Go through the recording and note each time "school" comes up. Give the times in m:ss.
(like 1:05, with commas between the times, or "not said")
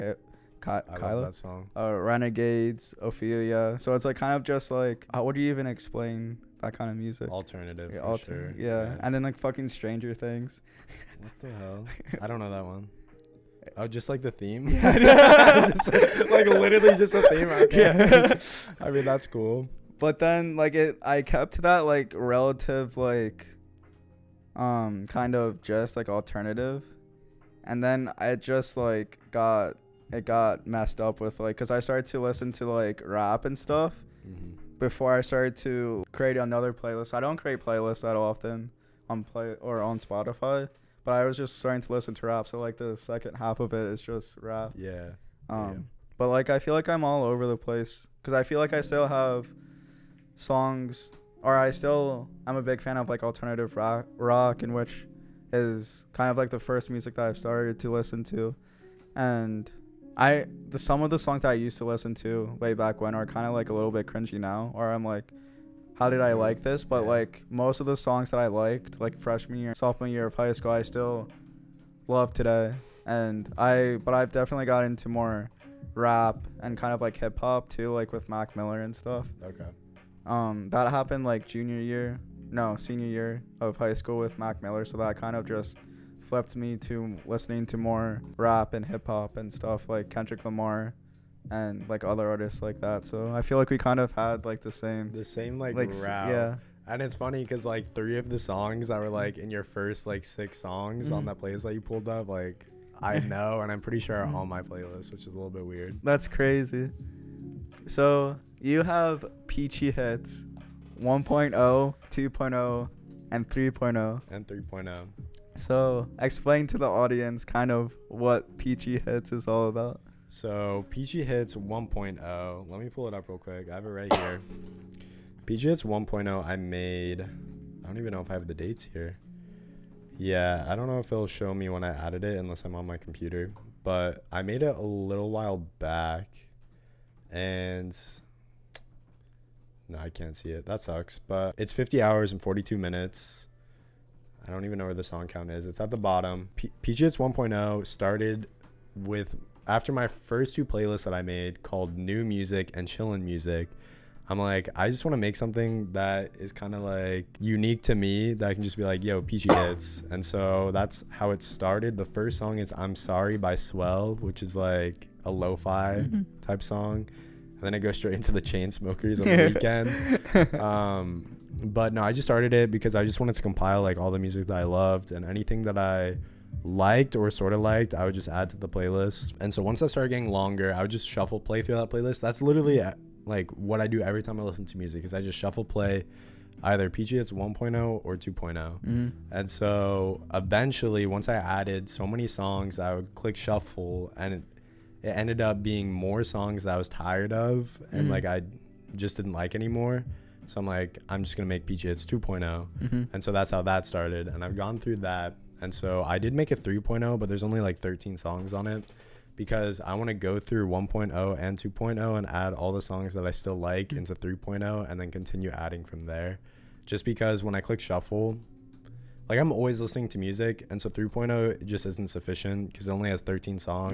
1:10, 1:23.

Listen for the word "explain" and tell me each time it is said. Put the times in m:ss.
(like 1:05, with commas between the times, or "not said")
0:05, 1:56.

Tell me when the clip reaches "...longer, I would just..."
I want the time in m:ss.
3:00.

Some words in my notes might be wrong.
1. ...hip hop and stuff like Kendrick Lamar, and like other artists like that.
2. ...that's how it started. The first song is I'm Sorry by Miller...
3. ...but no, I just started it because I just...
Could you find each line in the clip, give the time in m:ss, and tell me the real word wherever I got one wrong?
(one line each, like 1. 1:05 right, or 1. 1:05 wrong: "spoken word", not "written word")
1. 1:28 right
2. 2:40 wrong: "Swell", not "Miller"
3. 2:51 right.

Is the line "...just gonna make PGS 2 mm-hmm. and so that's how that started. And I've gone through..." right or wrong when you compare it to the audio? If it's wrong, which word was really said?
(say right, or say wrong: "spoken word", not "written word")
right.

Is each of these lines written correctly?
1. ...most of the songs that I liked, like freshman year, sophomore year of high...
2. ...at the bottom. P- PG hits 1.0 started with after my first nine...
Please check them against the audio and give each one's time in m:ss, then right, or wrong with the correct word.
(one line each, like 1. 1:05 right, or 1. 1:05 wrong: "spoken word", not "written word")
1. 1:07 right
2. 2:25 wrong: "two", not "nine".